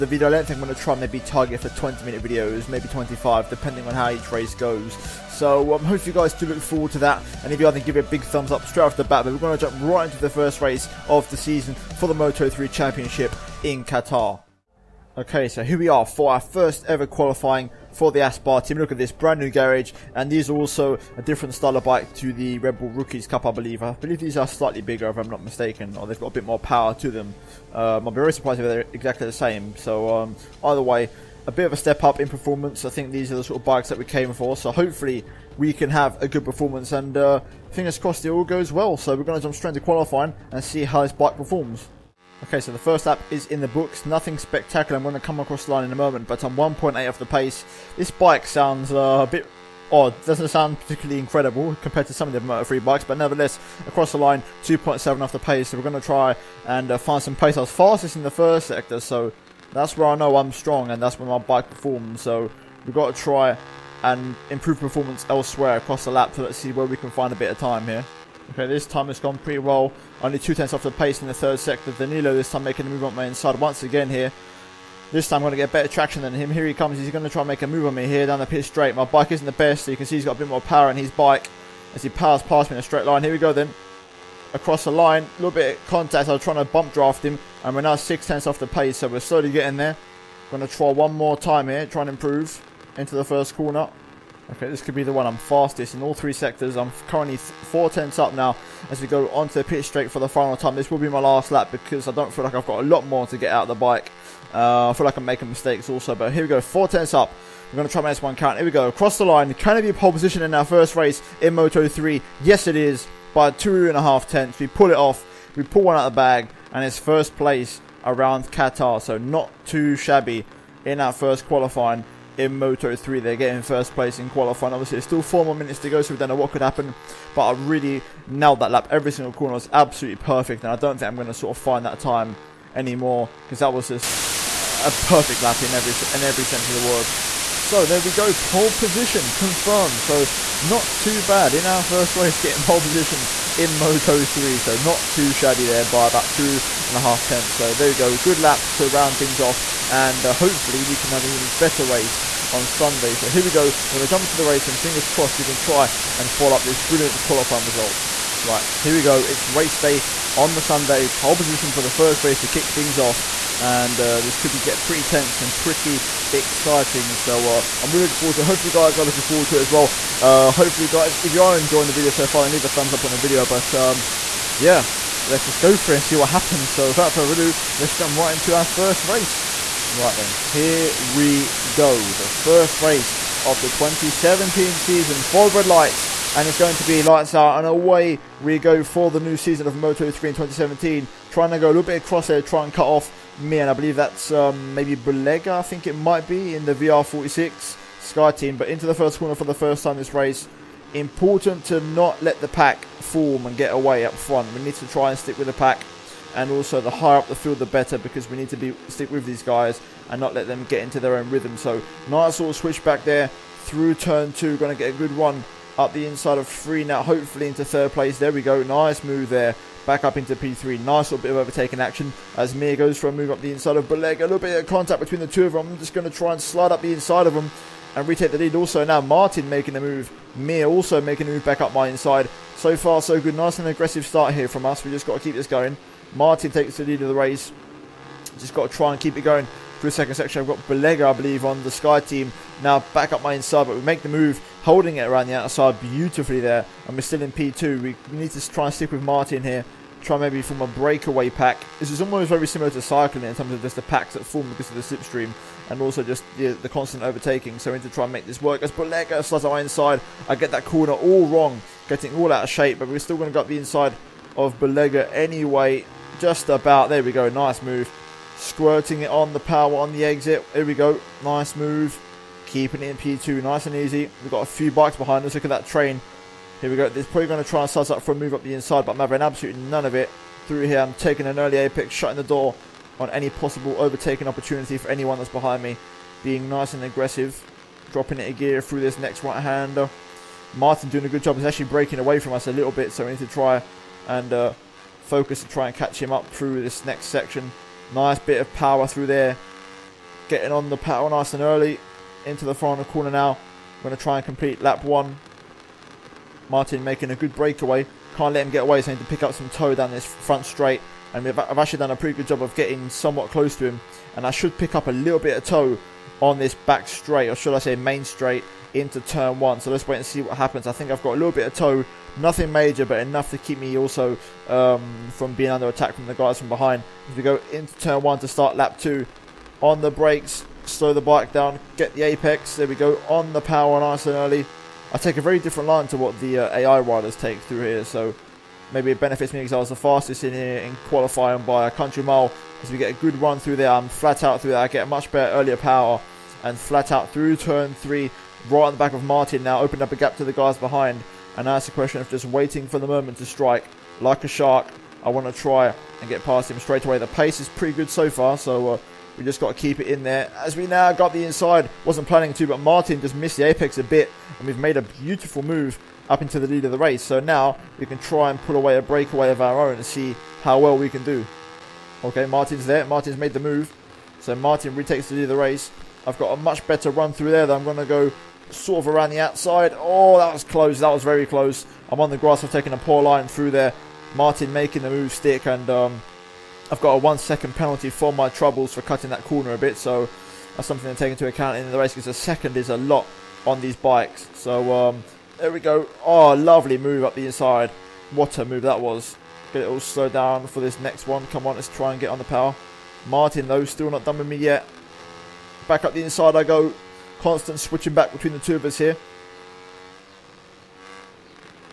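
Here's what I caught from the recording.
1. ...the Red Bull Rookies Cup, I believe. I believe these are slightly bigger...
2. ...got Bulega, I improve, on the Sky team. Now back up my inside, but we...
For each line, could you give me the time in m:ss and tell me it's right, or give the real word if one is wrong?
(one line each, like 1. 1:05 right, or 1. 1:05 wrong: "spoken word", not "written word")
1. 0:22 right
2. 4:00 wrong: "believe", not "improve".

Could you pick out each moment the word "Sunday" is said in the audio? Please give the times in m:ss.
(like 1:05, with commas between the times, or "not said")
2:32, 2:40.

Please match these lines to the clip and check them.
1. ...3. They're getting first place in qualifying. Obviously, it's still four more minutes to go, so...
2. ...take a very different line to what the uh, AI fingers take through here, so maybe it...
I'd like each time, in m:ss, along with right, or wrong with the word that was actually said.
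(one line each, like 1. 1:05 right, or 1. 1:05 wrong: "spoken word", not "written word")
1. 2:02 right
2. 5:34 wrong: "riders", not "fingers".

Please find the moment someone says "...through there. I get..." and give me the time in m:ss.
5:44.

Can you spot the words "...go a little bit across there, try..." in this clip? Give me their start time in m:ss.
3:11.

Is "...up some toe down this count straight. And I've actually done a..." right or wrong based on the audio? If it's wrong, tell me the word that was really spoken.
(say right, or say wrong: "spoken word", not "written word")
wrong: "front", not "count".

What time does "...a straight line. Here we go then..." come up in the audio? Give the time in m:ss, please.
1:22.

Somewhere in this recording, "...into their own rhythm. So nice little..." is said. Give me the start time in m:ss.
3:30.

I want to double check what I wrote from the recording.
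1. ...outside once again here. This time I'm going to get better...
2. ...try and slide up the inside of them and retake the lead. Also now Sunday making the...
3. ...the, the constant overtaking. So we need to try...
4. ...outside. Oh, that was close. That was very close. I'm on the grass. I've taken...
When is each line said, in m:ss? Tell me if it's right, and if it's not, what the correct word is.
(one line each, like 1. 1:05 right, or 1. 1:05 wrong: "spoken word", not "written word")
1. 1:13 wrong: "inside", not "outside"
2. 3:46 wrong: "Martin", not "Sunday"
3. 4:16 right
4. 6:19 right.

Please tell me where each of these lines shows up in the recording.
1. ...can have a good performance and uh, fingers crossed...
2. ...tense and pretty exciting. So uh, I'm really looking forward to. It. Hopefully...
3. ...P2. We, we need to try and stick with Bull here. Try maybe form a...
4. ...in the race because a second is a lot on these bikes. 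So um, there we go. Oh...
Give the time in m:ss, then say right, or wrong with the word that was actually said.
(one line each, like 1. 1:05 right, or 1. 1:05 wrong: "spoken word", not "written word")
1. 0:35 right
2. 2:45 right
3. 4:07 wrong: "Martin", not "Bull"
4. 6:31 right.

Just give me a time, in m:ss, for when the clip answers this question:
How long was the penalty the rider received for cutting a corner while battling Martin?
6:26.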